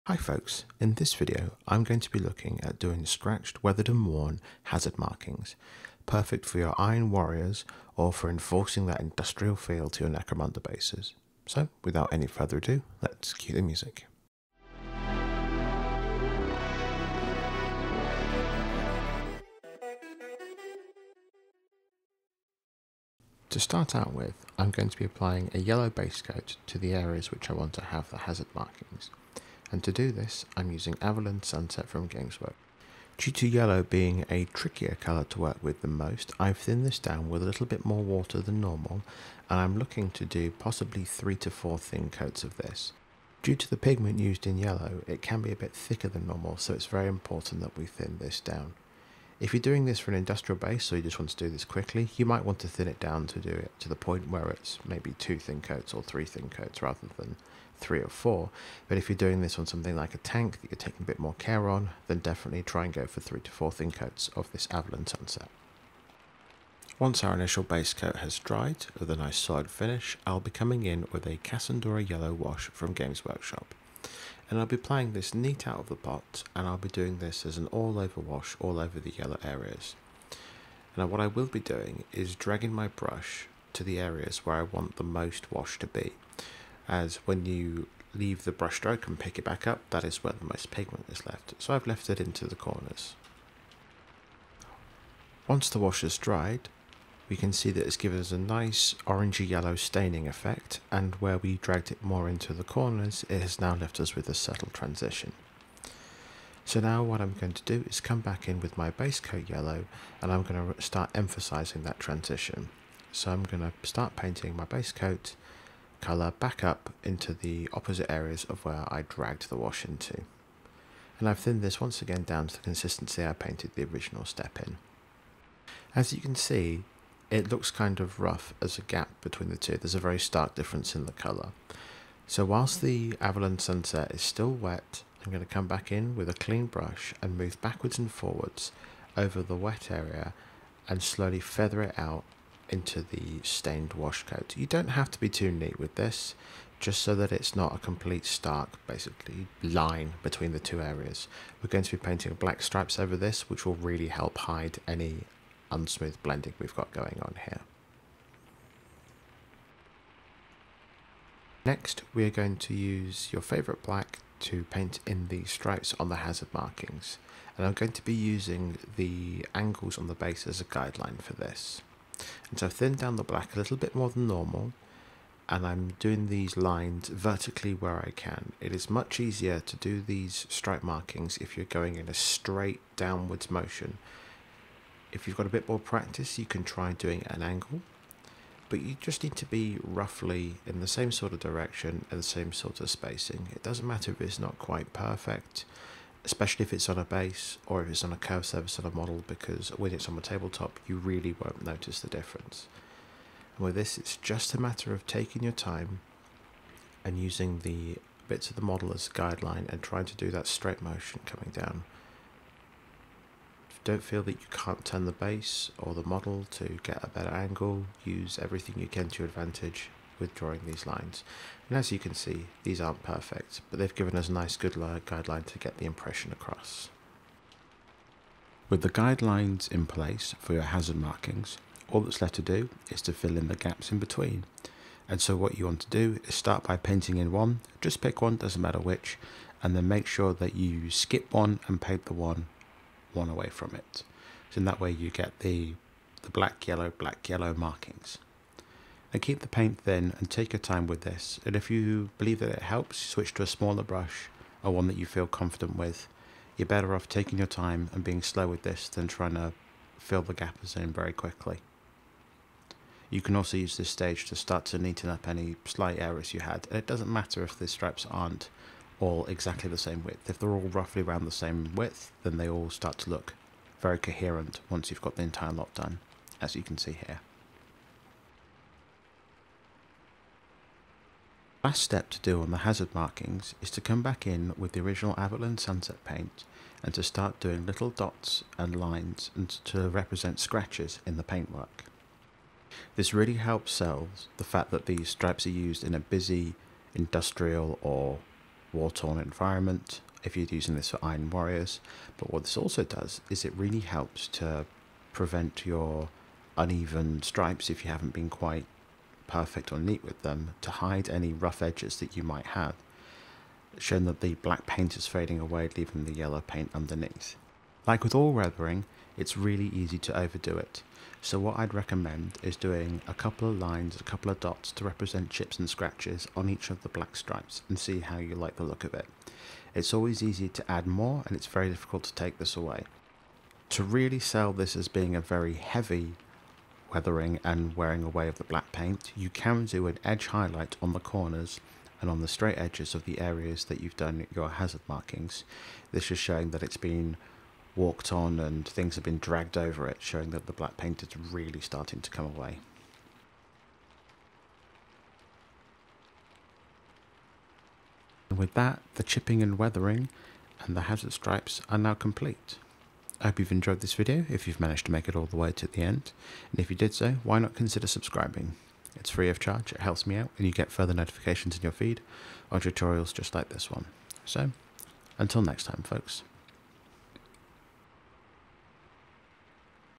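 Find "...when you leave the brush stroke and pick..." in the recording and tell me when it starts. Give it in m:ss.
1:27.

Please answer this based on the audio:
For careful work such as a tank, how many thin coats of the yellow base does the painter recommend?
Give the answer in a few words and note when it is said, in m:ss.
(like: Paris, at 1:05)
3 to 4, at 1:03.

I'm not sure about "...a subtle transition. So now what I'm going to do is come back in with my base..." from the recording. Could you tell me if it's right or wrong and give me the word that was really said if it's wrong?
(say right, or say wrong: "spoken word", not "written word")
right.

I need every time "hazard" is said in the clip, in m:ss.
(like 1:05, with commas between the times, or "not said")
0:04, 0:28, 2:46, 3:50, 4:42, 5:44, 6:00.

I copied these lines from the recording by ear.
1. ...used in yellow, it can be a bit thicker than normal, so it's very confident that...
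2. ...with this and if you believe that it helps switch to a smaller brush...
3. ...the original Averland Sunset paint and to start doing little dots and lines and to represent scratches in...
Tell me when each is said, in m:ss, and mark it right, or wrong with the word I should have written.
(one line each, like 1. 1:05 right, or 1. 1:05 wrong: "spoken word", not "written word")
1. 0:44 wrong: "important", not "confident"
2. 4:10 right
3. 4:44 right.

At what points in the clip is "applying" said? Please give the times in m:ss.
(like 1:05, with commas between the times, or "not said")
0:25, 1:14.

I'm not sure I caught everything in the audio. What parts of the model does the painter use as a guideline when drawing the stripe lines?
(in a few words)
The angles on the base.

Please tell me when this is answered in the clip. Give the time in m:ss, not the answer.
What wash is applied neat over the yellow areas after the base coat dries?
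1:11.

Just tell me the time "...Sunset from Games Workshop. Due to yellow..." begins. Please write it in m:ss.
0:31.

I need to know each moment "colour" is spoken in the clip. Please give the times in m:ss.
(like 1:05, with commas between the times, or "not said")
0:34, 1:56, 2:11.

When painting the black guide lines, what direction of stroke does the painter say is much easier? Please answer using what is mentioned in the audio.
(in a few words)
Vertically.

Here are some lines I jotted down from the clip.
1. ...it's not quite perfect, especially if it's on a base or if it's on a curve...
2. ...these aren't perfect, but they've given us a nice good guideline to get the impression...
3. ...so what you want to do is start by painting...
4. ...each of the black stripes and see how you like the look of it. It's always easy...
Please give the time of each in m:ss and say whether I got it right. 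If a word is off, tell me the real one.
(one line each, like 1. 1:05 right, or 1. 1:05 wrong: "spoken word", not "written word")
1. 3:14 right
2. 3:42 right
3. 3:55 right
4. 5:26 right.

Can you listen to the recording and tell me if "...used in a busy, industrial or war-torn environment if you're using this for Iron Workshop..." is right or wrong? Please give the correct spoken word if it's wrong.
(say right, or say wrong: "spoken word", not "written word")
wrong: "Warriors", not "Workshop".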